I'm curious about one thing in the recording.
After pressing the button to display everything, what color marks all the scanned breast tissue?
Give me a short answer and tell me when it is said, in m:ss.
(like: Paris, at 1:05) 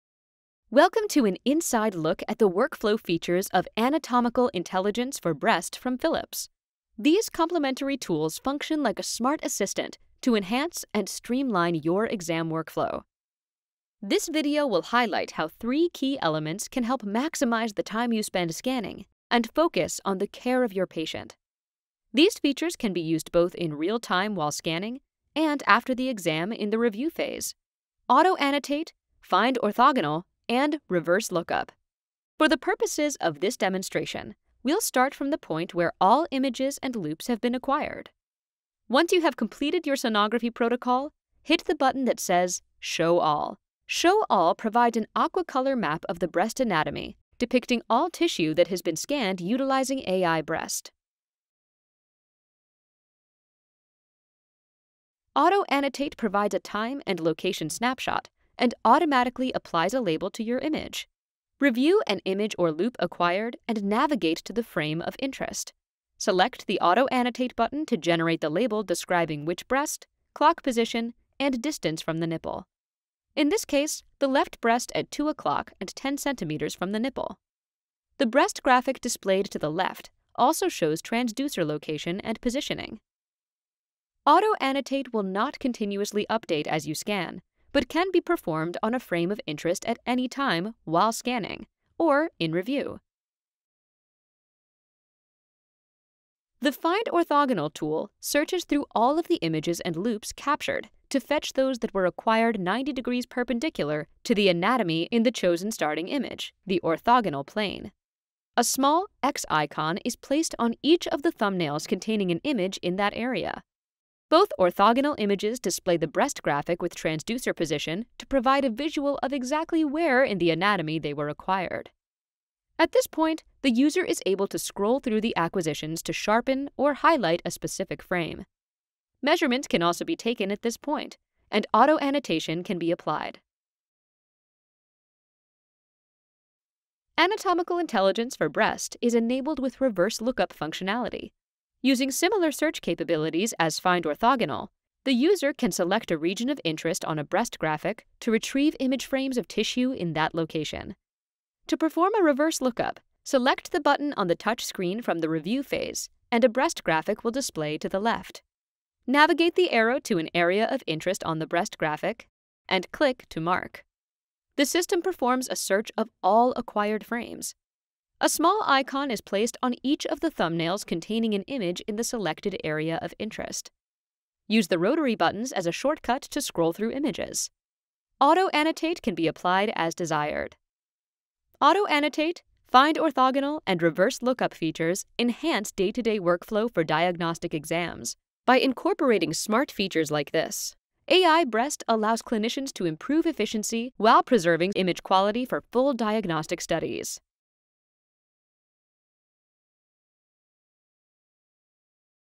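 Aqua, at 0:45.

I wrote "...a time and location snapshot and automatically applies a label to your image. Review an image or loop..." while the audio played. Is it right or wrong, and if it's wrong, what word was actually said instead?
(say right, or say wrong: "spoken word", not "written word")
right.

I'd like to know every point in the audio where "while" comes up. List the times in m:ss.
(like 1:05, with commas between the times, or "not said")
0:24, 1:30, 3:13.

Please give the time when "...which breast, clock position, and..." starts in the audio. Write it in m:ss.
1:09.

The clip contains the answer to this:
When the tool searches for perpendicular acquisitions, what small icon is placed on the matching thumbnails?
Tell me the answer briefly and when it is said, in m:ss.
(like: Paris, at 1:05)
X icon, at 1:49.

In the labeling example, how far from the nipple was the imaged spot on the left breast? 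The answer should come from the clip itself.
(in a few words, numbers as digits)
10 centimeters.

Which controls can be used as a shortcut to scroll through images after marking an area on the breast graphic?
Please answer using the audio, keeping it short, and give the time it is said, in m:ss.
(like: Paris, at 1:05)
Rotary buttons, at 2:54.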